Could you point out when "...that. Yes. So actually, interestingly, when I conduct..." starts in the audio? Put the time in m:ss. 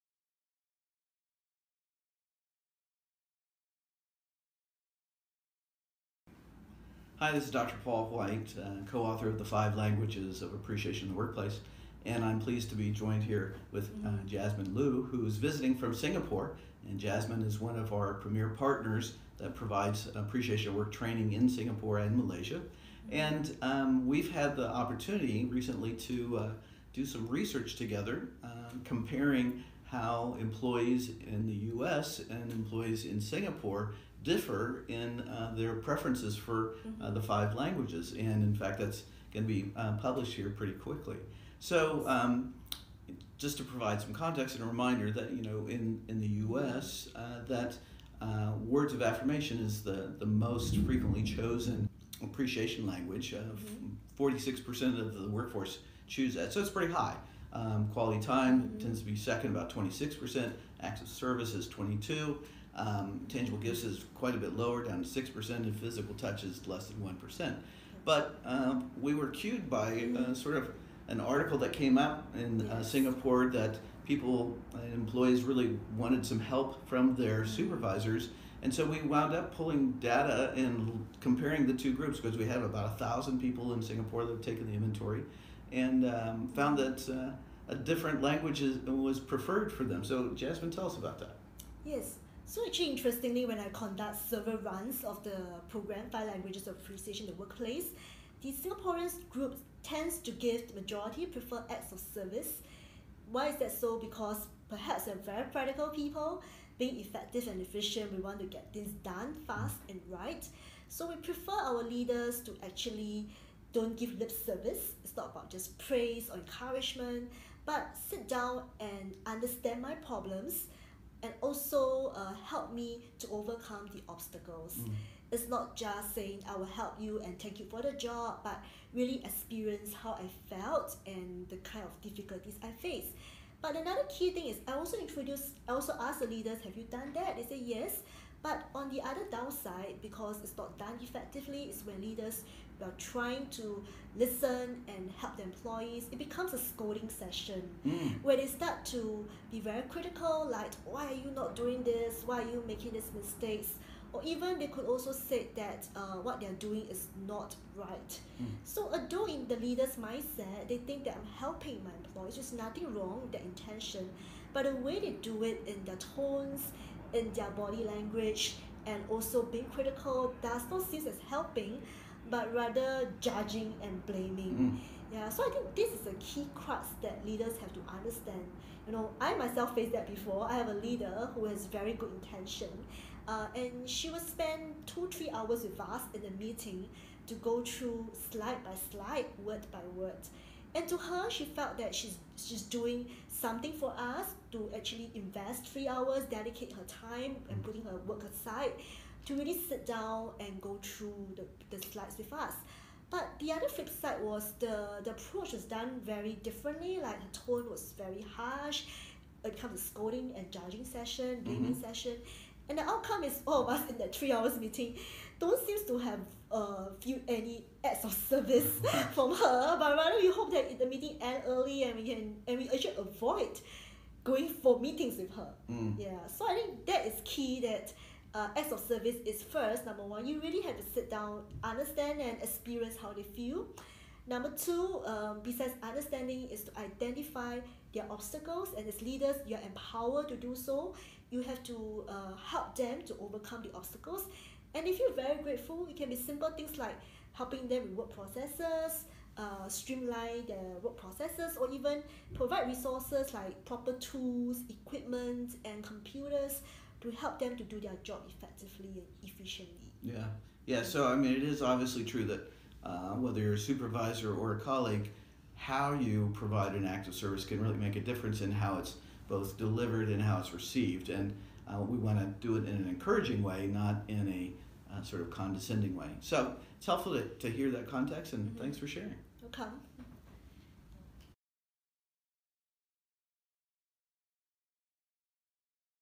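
1:31.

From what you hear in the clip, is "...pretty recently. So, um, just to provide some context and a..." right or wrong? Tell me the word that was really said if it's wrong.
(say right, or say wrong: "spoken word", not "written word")
wrong: "quickly", not "recently".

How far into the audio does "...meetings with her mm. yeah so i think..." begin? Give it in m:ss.
3:44.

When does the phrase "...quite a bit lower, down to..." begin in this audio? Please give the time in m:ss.
1:04.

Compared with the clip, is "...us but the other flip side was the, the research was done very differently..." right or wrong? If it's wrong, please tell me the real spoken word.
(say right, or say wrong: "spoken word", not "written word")
wrong: "approach", not "research".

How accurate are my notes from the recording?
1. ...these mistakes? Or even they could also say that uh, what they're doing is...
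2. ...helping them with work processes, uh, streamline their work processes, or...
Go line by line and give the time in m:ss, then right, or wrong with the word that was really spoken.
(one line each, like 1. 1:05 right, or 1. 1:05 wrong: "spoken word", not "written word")
1. 2:32 right
2. 4:07 right.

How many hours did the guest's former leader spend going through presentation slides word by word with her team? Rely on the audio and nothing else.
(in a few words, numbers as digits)
2 to 3 hours.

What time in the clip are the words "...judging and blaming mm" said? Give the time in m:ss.
2:53.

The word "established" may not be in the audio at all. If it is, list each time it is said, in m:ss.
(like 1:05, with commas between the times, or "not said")
not said.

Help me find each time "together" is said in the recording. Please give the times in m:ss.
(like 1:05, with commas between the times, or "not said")
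0:27.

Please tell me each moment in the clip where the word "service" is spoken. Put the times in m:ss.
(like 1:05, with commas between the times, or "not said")
1:01, 1:42, 1:54, 3:38, 3:48, 4:27.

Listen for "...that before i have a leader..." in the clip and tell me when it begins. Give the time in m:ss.
2:59.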